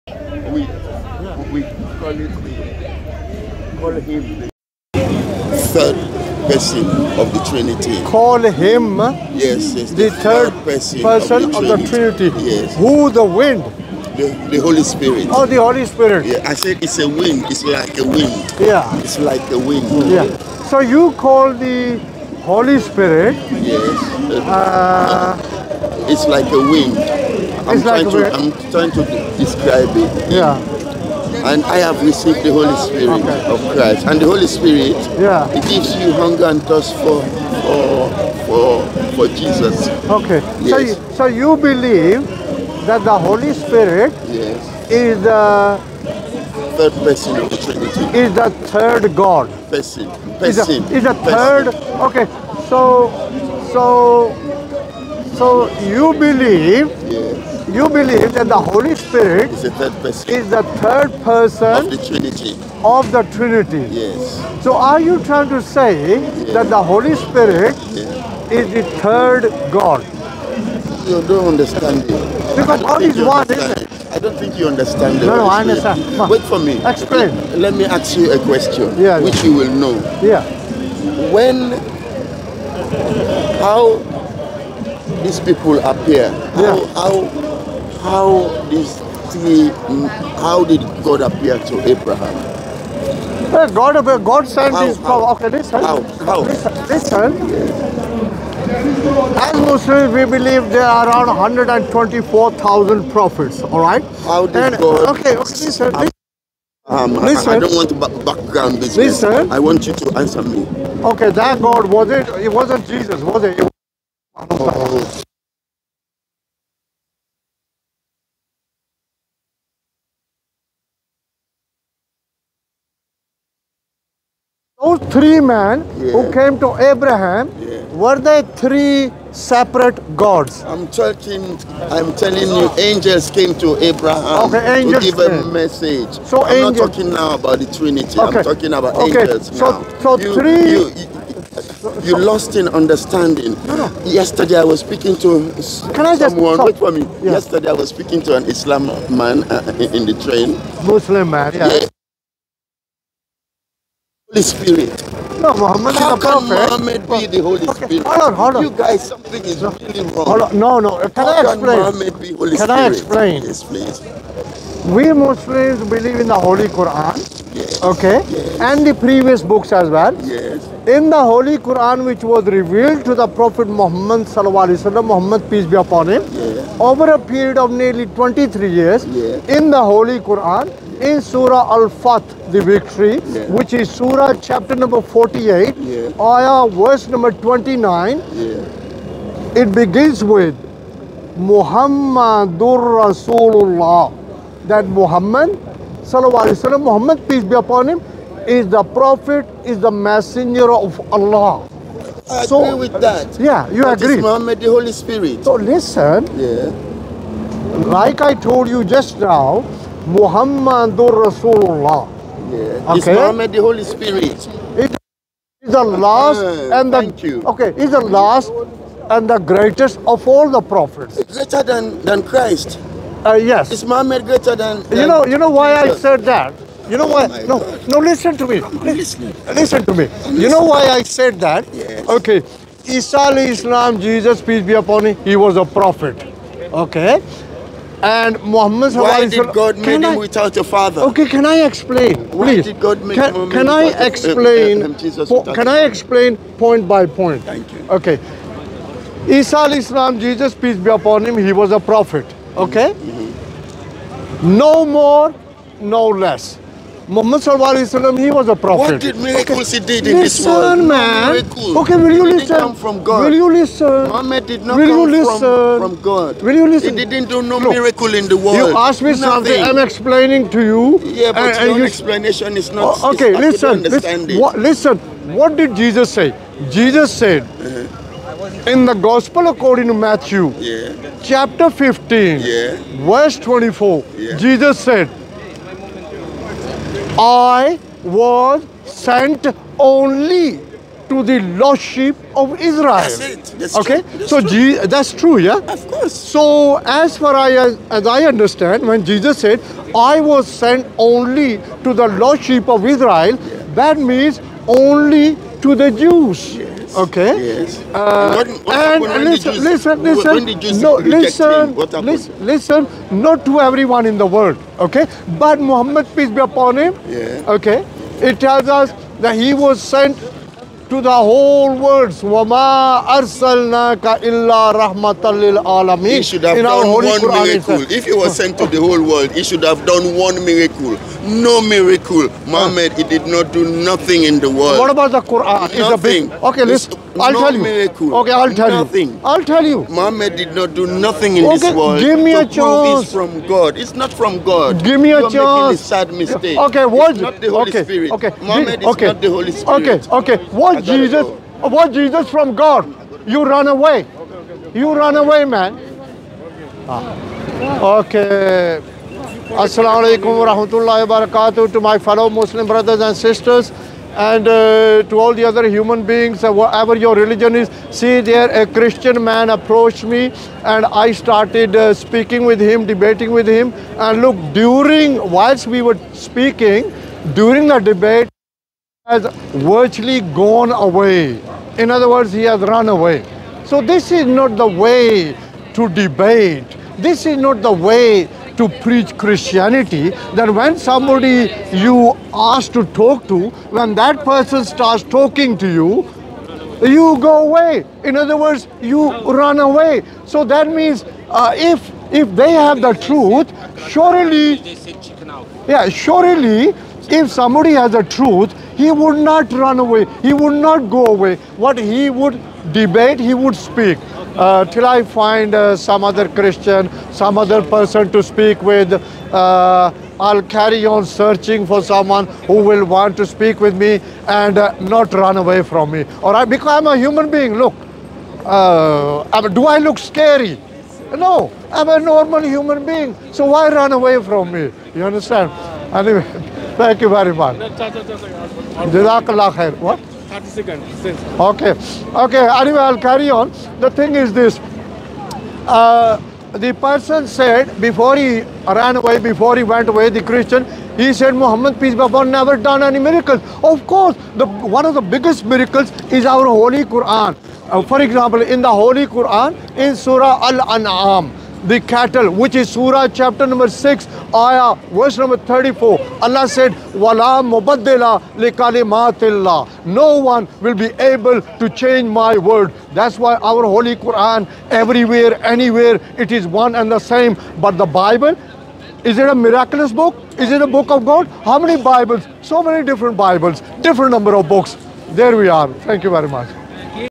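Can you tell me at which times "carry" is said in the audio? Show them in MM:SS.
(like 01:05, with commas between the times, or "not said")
07:00, 07:22.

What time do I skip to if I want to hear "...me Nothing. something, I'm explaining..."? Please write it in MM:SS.
04:29.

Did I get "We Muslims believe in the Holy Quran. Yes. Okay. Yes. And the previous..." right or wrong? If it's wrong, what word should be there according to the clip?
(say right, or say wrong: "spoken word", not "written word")
right.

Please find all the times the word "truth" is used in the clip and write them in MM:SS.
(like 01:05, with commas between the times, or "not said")
06:42, 06:48.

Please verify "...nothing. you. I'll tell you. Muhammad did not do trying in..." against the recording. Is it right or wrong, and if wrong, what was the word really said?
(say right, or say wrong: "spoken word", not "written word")
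wrong: "nothing", not "trying".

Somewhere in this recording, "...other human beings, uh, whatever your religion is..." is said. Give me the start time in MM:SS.
06:05.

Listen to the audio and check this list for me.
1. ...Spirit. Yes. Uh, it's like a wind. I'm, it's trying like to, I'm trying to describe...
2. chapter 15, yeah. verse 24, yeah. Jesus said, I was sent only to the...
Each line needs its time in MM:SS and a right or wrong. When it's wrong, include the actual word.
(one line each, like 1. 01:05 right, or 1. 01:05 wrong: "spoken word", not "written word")
1. 00:22 right
2. 04:41 right.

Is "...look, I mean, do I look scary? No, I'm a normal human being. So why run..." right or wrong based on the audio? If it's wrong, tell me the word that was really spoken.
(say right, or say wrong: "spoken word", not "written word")
right.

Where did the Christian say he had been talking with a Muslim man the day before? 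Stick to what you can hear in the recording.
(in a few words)
the train.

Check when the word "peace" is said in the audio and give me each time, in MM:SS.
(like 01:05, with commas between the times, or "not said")
02:55, 03:17, 03:54, 04:10, 05:16, 07:31.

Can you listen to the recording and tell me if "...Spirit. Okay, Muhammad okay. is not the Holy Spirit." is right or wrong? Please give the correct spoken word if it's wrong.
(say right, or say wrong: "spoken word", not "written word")
right.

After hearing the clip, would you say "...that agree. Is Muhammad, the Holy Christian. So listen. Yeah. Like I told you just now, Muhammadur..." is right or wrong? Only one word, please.
wrong.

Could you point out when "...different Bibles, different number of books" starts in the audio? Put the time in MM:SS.
08:02.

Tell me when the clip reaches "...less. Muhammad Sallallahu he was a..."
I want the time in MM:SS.
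04:16.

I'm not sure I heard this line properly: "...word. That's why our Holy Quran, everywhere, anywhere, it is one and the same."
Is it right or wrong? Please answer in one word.
right.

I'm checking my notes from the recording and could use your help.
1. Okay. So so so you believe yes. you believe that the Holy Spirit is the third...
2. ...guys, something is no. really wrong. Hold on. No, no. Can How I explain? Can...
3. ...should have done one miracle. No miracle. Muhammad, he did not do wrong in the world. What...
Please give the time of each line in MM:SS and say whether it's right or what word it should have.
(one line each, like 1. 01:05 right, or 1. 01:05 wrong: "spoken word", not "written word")
1. 00:52 right
2. 02:38 right
3. 05:29 wrong: "nothing", not "wrong".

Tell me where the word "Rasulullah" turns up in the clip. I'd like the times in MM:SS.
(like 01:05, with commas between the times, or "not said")
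03:13, 03:31.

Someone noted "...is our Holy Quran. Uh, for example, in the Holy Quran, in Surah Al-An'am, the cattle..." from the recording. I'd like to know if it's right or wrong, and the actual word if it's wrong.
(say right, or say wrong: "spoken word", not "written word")
right.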